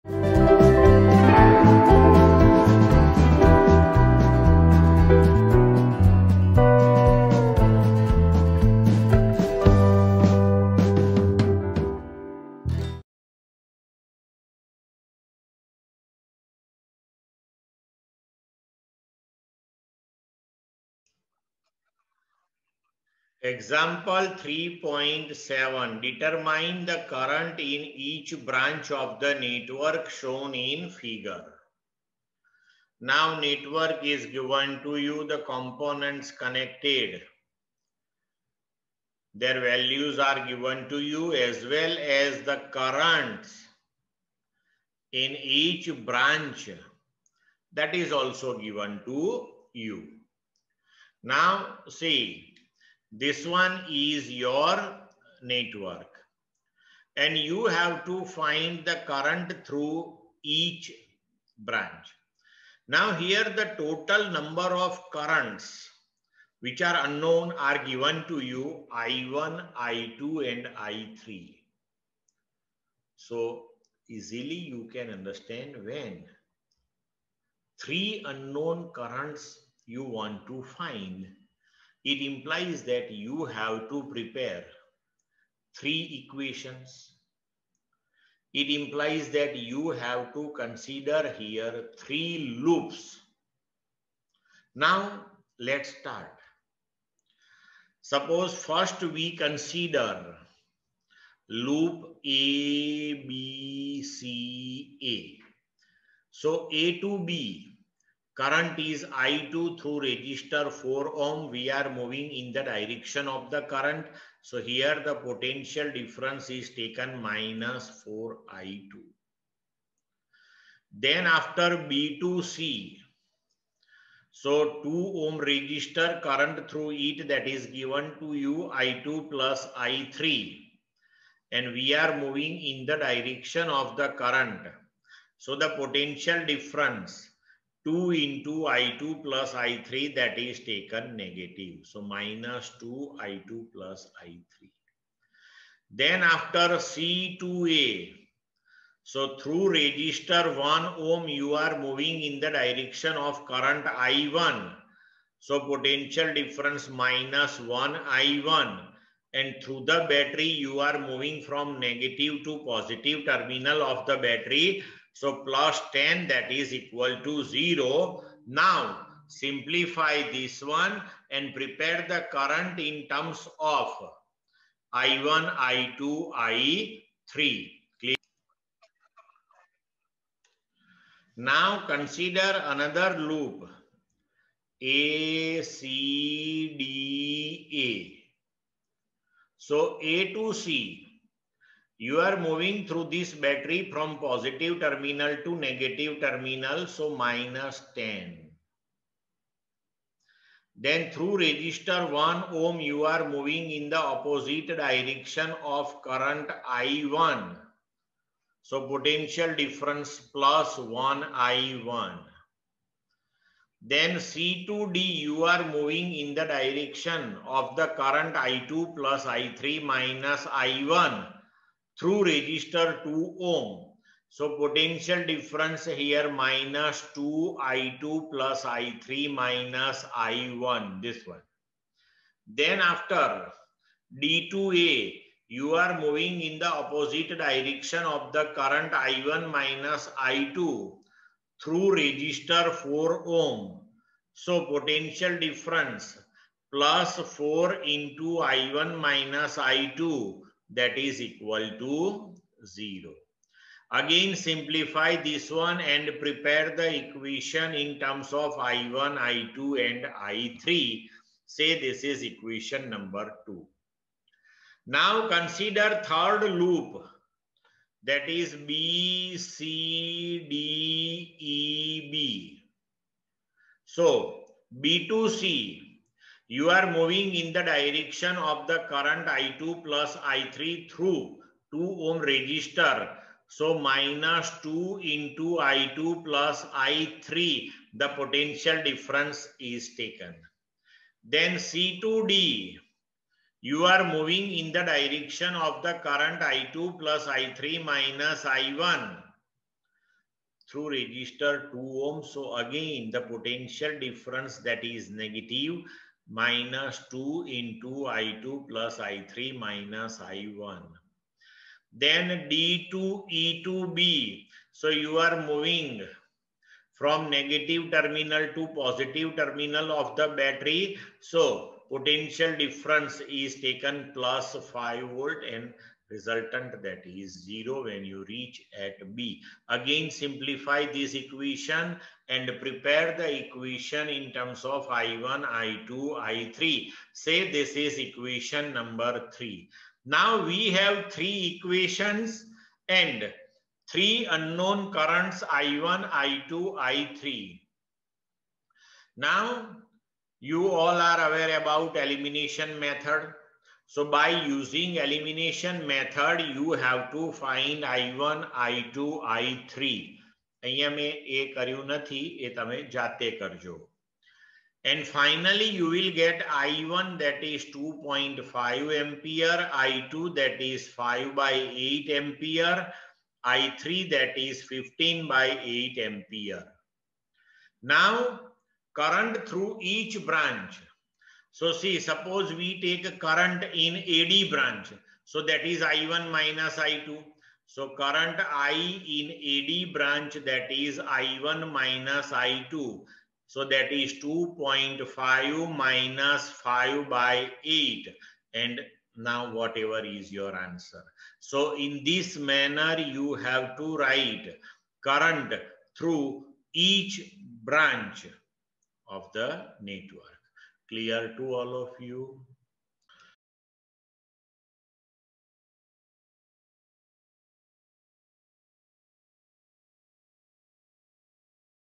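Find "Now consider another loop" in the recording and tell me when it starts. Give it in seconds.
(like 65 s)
181 s.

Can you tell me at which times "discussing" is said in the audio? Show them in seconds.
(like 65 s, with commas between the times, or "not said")
not said.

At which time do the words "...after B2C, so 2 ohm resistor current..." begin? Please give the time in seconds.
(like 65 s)
121 s.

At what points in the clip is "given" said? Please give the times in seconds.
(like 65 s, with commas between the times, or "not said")
34 s, 40 s, 48 s, 67 s, 127 s.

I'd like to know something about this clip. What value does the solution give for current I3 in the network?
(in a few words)
15/8 ampere.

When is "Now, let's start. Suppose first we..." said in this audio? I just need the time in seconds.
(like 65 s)
94 s.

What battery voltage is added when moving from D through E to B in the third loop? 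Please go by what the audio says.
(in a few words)
5 volt.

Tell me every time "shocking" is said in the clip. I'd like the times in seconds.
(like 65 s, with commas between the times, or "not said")
not said.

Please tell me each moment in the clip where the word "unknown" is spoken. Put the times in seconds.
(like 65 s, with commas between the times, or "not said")
67 s, 78 s, 344 s.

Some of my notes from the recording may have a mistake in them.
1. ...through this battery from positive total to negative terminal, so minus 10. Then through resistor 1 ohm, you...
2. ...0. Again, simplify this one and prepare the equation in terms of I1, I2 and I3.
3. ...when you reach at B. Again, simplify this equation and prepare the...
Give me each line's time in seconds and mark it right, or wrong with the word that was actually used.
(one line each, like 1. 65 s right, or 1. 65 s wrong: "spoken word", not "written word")
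1. 192 s wrong: "terminal", not "total"
2. 252 s right
3. 327 s right.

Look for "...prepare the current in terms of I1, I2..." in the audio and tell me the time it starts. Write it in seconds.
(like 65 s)
171 s.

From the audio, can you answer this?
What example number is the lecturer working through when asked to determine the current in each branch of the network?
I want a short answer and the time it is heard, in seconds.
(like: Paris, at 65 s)
3.7, at 24 s.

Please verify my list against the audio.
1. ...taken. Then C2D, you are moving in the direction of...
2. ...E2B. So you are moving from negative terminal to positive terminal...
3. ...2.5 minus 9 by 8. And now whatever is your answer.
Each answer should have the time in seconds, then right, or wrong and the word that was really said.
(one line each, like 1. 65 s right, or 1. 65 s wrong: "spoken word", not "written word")
1. 289 s right
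2. 313 s right
3. 394 s wrong: "5", not "9".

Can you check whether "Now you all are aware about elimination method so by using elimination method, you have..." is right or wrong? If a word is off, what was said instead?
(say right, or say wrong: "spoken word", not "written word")
right.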